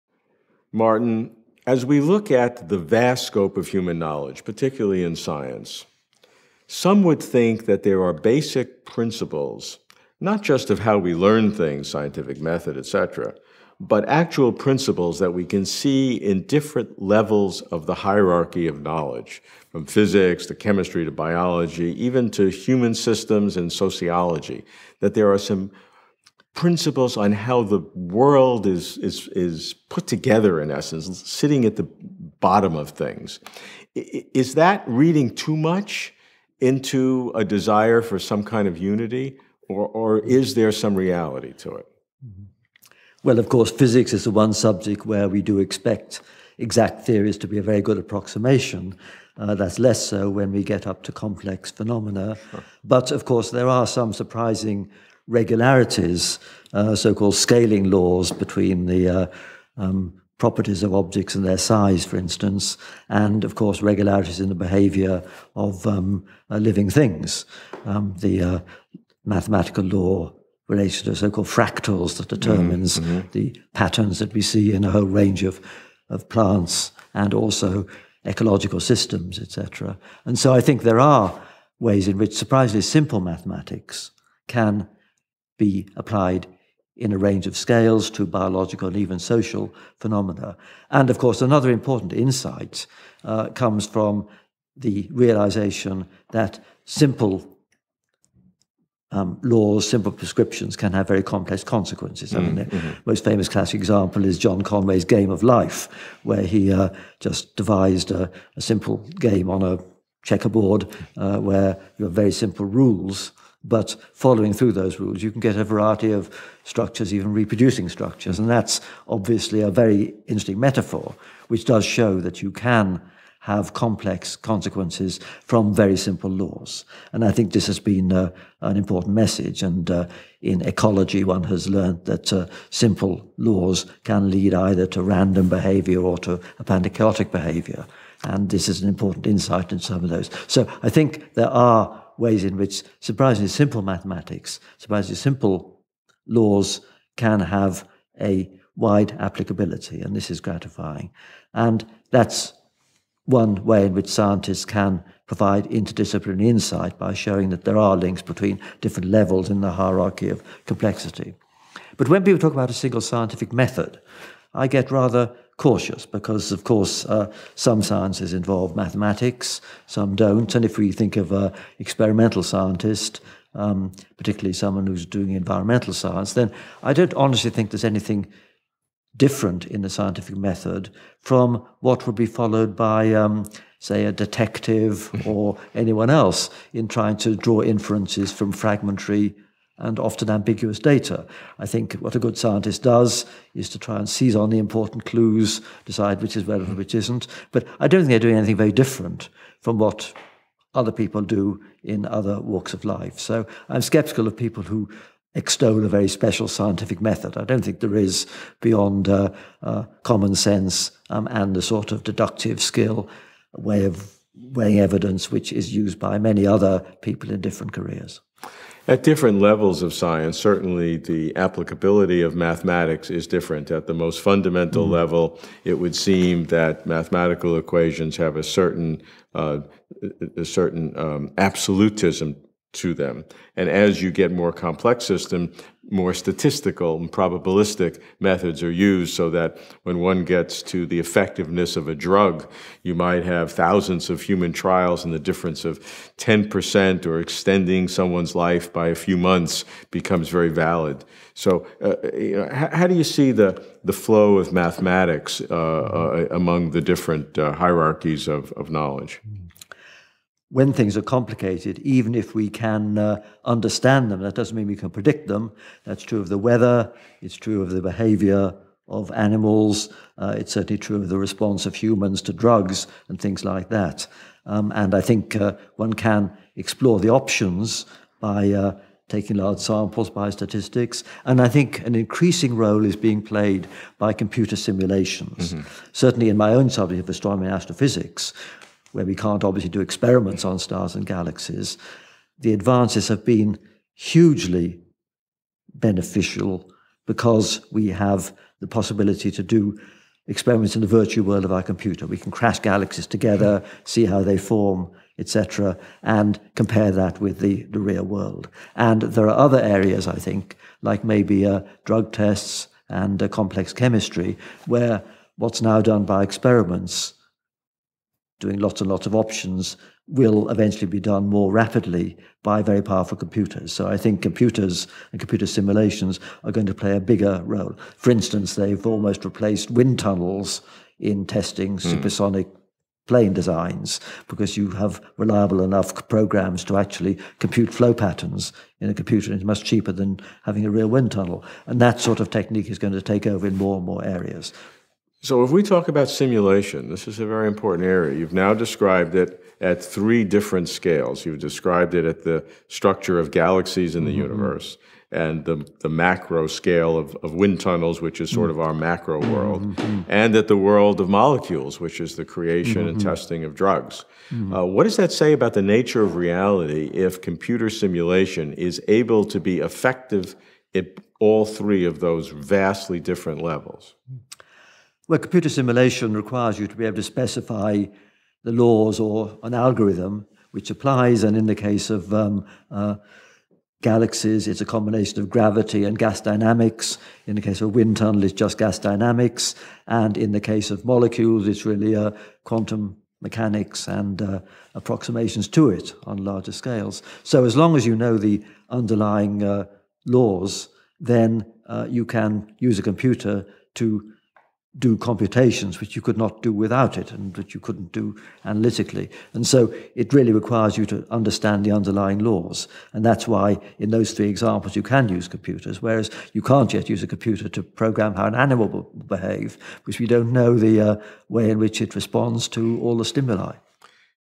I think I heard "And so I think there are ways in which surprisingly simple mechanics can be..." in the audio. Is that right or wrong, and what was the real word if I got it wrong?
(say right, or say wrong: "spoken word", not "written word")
wrong: "mathematics", not "mechanics".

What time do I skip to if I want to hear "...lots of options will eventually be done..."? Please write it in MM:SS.
05:18.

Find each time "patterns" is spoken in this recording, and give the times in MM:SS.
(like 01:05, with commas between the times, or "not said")
01:13, 05:37.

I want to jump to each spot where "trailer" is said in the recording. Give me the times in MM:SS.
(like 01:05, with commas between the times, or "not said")
not said.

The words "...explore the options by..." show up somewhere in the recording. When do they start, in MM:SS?
04:36.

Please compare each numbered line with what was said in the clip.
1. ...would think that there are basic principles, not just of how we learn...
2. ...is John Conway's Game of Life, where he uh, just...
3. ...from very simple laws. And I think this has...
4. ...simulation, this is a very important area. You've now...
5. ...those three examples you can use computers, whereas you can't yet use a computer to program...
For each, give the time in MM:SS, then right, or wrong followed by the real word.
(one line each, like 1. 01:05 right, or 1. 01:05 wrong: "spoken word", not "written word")
1. 00:07 right
2. 01:44 right
3. 02:05 right
4. 05:46 right
5. 06:53 right.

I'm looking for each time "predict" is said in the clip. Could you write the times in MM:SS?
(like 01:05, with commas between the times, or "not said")
04:24.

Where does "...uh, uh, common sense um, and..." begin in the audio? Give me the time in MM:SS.
03:29.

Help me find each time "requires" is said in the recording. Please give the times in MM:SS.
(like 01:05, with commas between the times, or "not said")
06:16, 06:50.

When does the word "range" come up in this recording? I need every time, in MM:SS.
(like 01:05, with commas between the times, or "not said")
01:15, 01:27.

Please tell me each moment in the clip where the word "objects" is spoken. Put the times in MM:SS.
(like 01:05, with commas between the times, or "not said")
01:00.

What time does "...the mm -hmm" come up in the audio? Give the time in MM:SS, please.
05:54.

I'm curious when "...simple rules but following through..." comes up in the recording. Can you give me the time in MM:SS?
01:52.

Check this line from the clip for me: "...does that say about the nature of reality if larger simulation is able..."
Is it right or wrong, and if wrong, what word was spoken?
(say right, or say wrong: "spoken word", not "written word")
wrong: "computer", not "larger".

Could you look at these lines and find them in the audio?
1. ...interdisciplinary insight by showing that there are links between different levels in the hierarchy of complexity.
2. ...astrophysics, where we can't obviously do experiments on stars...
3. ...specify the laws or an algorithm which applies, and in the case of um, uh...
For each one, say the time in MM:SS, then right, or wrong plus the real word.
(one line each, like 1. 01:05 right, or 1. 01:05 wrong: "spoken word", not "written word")
1. 02:35 right
2. 04:47 right
3. 06:17 right.